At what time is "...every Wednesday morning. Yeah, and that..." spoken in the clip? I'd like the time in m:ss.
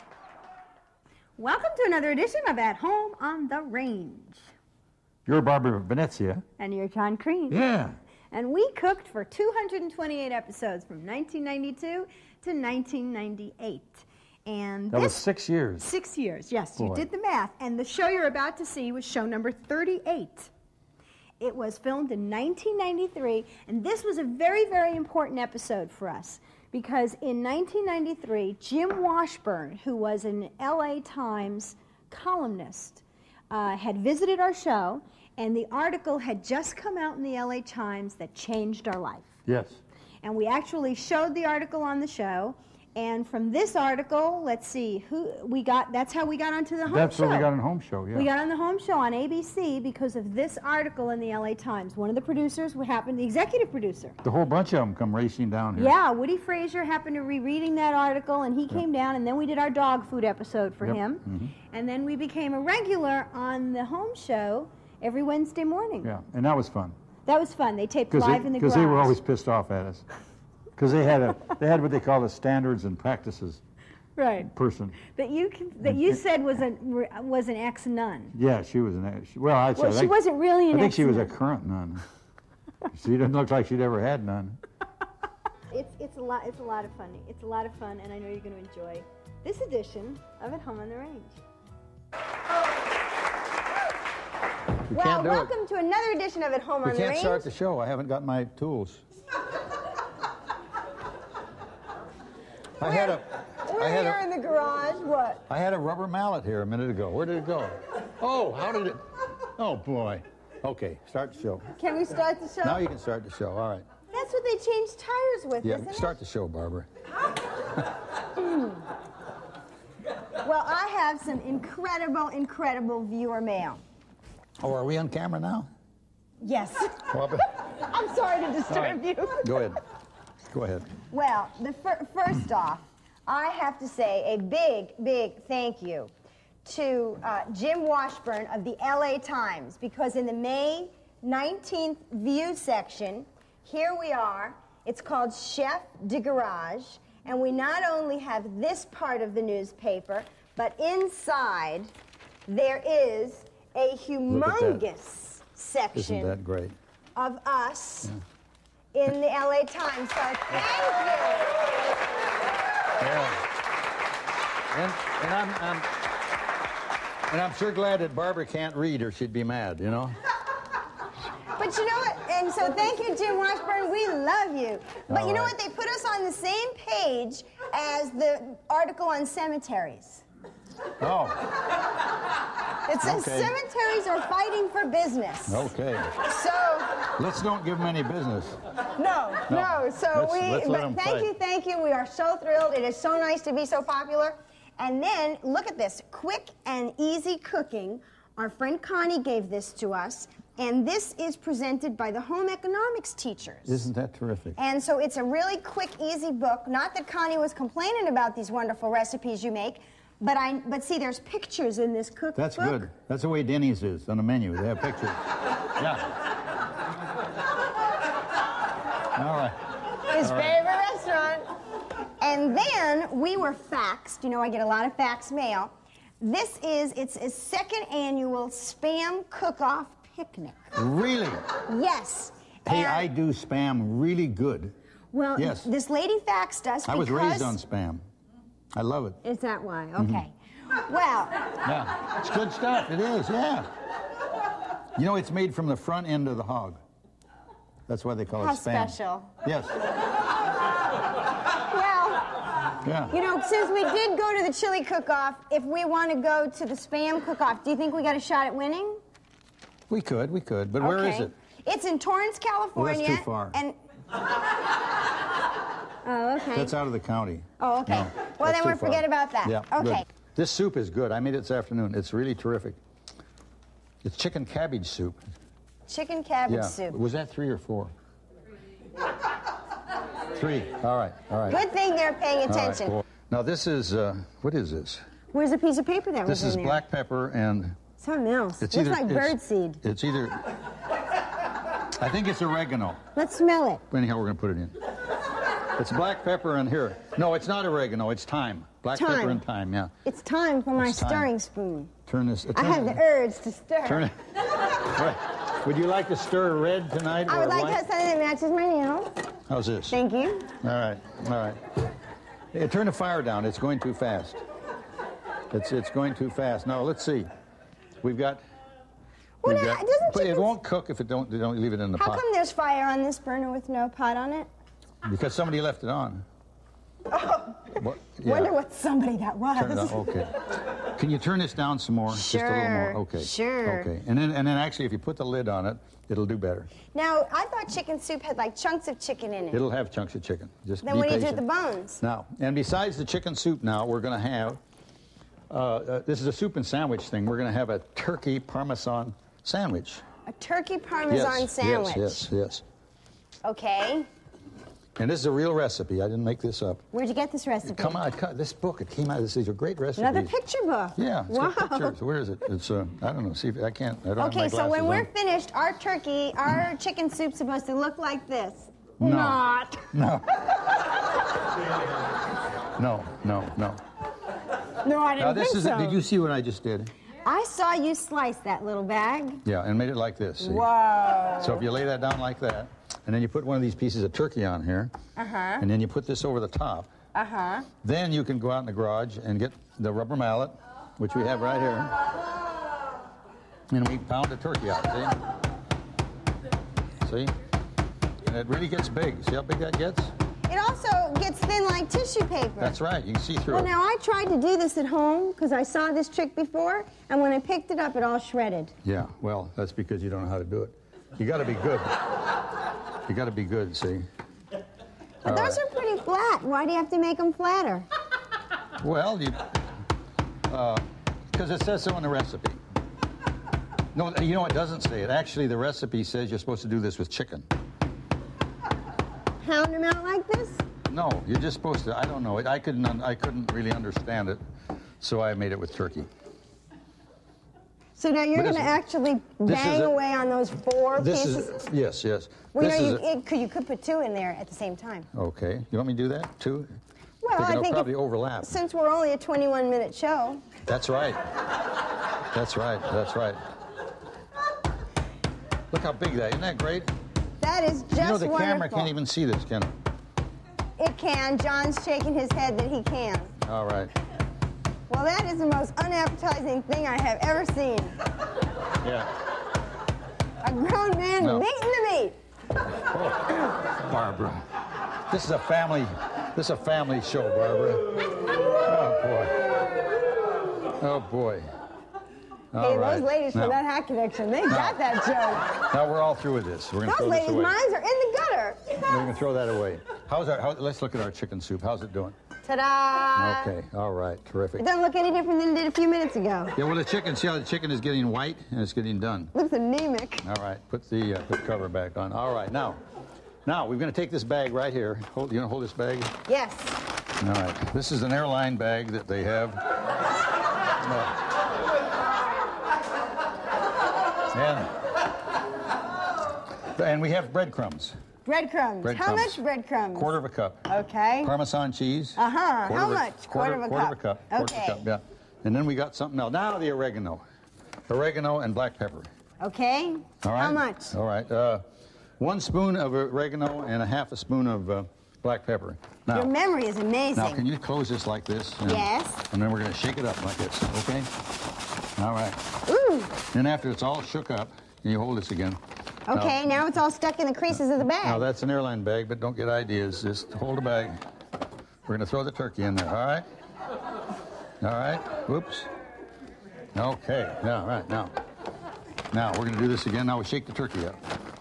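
1:05.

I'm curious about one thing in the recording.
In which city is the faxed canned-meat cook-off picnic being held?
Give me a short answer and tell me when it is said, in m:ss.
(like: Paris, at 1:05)
Torrance, California, at 4:21.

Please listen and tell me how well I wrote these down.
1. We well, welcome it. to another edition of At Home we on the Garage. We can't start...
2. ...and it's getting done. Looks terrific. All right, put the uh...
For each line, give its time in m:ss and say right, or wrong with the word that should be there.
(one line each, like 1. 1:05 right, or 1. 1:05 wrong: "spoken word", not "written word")
1. 1:34 wrong: "Range", not "Garage"
2. 8:18 wrong: "anemic", not "terrific".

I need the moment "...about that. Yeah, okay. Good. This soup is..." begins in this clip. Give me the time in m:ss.
4:29.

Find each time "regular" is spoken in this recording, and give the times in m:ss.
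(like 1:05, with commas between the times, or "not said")
1:02.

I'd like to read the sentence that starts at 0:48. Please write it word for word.
Yeah, we got on the home show on ABC because of this article in the LA Times.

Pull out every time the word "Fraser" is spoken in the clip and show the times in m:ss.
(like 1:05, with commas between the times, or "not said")
0:56.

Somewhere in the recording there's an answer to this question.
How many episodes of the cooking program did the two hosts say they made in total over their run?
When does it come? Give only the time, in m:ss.
0:09.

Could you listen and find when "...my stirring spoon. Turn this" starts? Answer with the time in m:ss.
5:00.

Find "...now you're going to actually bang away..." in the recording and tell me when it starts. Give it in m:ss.
7:18.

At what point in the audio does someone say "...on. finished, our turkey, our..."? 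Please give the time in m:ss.
6:04.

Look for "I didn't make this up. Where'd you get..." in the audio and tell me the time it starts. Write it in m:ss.
5:56.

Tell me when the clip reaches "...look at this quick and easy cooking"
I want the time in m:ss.
3:15.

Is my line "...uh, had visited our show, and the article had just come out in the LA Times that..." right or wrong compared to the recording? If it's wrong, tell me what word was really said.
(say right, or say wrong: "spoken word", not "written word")
right.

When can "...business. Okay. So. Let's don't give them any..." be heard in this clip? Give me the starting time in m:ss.
3:04.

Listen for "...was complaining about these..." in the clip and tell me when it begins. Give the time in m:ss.
3:27.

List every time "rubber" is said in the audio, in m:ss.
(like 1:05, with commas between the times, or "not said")
1:45, 6:29.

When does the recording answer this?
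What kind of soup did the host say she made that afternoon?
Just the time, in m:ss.
4:34.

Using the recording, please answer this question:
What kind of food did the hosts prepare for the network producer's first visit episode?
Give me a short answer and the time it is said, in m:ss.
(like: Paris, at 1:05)
Dog food, at 0:59.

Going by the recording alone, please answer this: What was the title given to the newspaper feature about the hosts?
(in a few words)
Chef de Garage.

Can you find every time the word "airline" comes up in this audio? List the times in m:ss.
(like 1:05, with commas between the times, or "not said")
8:28, 9:08.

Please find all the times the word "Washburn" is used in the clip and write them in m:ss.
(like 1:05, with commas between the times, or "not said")
0:29, 2:17, 2:53.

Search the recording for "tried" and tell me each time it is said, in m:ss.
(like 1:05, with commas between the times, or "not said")
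6:44.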